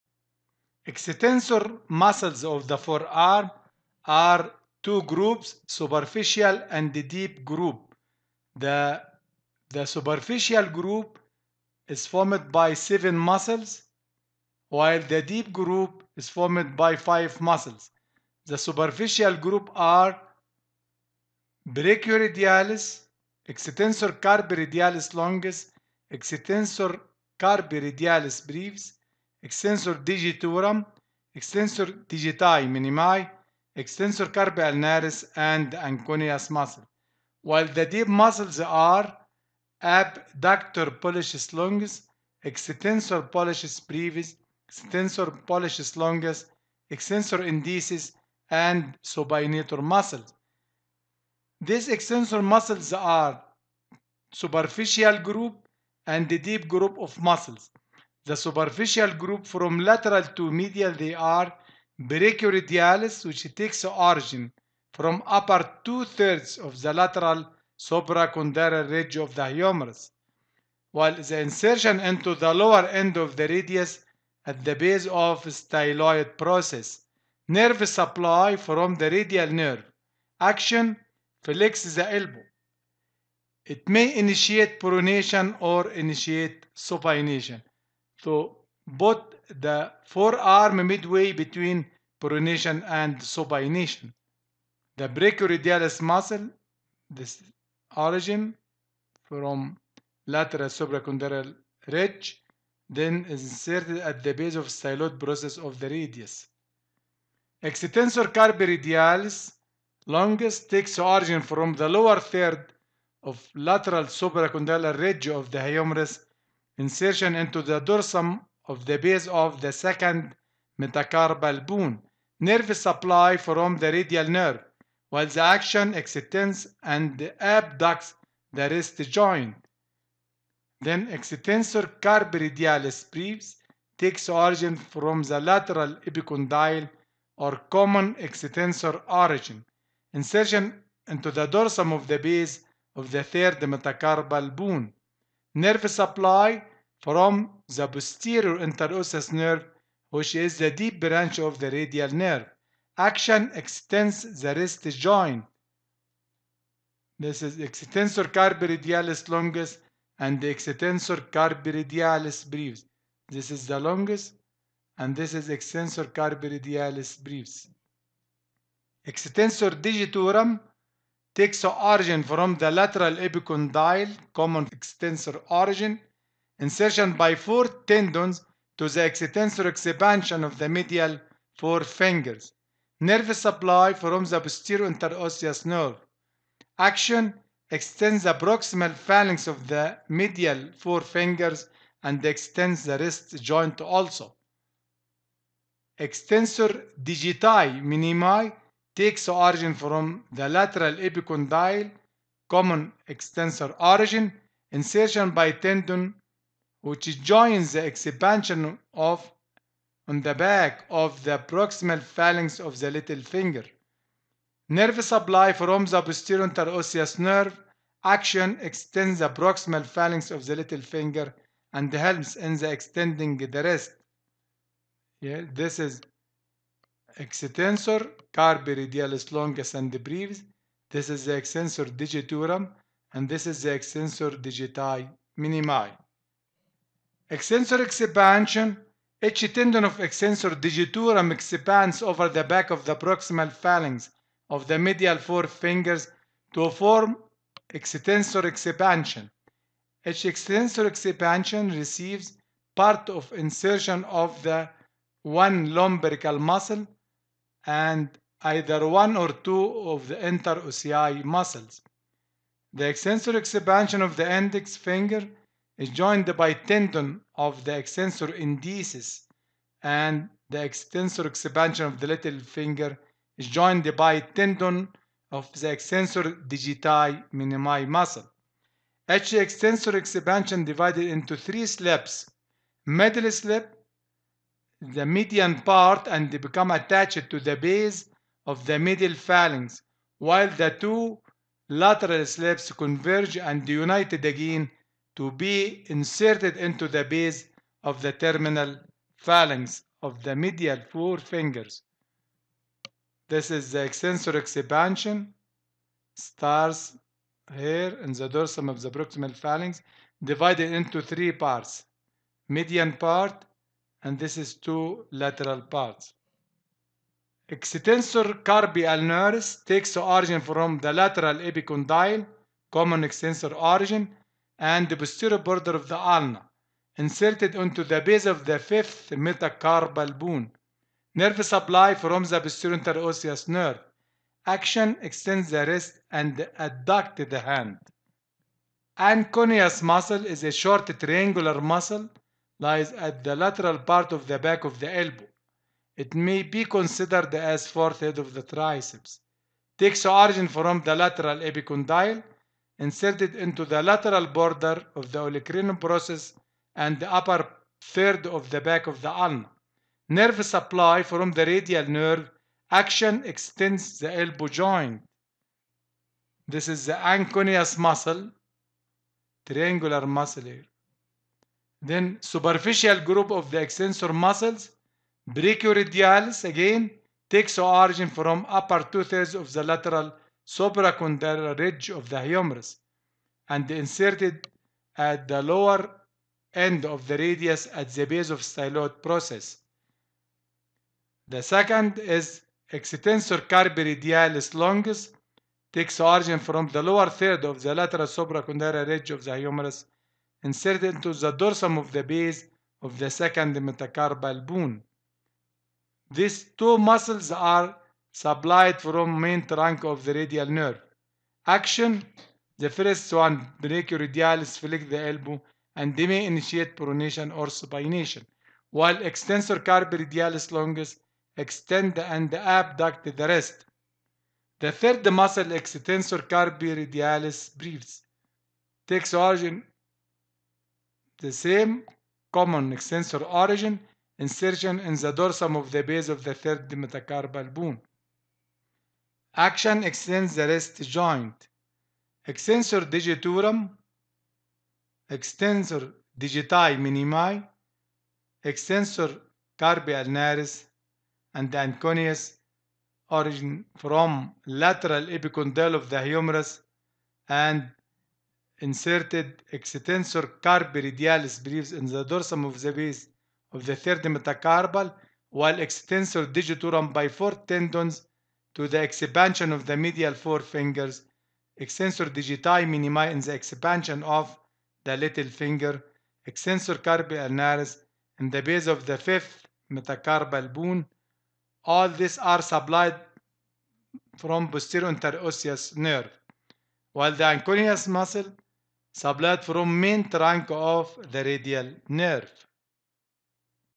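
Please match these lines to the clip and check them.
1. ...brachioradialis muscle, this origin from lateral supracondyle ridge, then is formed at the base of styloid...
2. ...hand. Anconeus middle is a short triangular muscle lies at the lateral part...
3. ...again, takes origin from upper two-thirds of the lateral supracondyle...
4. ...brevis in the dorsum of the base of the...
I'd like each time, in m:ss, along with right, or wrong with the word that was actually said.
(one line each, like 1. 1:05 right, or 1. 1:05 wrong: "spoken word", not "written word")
1. 1:35 wrong: "inserted", not "formed"
2. 5:37 wrong: "muscle", not "middle"
3. 6:16 right
4. 7:41 right.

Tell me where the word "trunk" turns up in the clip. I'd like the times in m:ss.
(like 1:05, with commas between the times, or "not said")
6:49, 8:10.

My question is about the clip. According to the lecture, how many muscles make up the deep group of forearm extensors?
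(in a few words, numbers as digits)
5.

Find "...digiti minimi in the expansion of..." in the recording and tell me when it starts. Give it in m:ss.
7:52.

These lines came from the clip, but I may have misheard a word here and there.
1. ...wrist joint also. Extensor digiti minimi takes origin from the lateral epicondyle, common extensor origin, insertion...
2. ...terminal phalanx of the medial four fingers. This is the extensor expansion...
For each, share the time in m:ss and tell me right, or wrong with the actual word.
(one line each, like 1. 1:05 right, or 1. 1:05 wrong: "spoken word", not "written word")
1. 3:12 right
2. 4:58 right.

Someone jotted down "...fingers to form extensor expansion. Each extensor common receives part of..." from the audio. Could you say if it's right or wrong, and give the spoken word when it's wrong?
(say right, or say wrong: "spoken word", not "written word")
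wrong: "expansion", not "common".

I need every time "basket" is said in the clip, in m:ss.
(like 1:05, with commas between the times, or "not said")
not said.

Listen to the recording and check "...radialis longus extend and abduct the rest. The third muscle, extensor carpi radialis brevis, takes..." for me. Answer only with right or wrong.
right.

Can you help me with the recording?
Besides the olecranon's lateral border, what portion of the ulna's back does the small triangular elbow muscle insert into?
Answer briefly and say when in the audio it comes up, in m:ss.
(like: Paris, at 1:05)
Upper third, at 5:57.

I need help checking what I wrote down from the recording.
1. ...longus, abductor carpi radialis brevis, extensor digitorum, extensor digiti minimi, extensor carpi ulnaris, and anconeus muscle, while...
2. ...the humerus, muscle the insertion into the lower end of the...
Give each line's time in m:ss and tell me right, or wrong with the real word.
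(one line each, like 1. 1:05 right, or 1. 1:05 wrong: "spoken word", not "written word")
1. 0:25 wrong: "extensor", not "abductor"
2. 1:09 wrong: "while", not "muscle".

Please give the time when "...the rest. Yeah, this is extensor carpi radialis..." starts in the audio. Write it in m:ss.
3:43.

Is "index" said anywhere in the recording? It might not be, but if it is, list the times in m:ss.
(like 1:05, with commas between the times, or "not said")
4:24.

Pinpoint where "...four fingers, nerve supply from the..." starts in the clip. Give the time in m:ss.
3:01.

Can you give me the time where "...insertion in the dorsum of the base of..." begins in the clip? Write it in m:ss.
7:14.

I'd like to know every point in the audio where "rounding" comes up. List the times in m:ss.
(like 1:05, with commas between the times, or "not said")
not said.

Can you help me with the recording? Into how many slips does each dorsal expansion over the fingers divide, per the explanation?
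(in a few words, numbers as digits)
3.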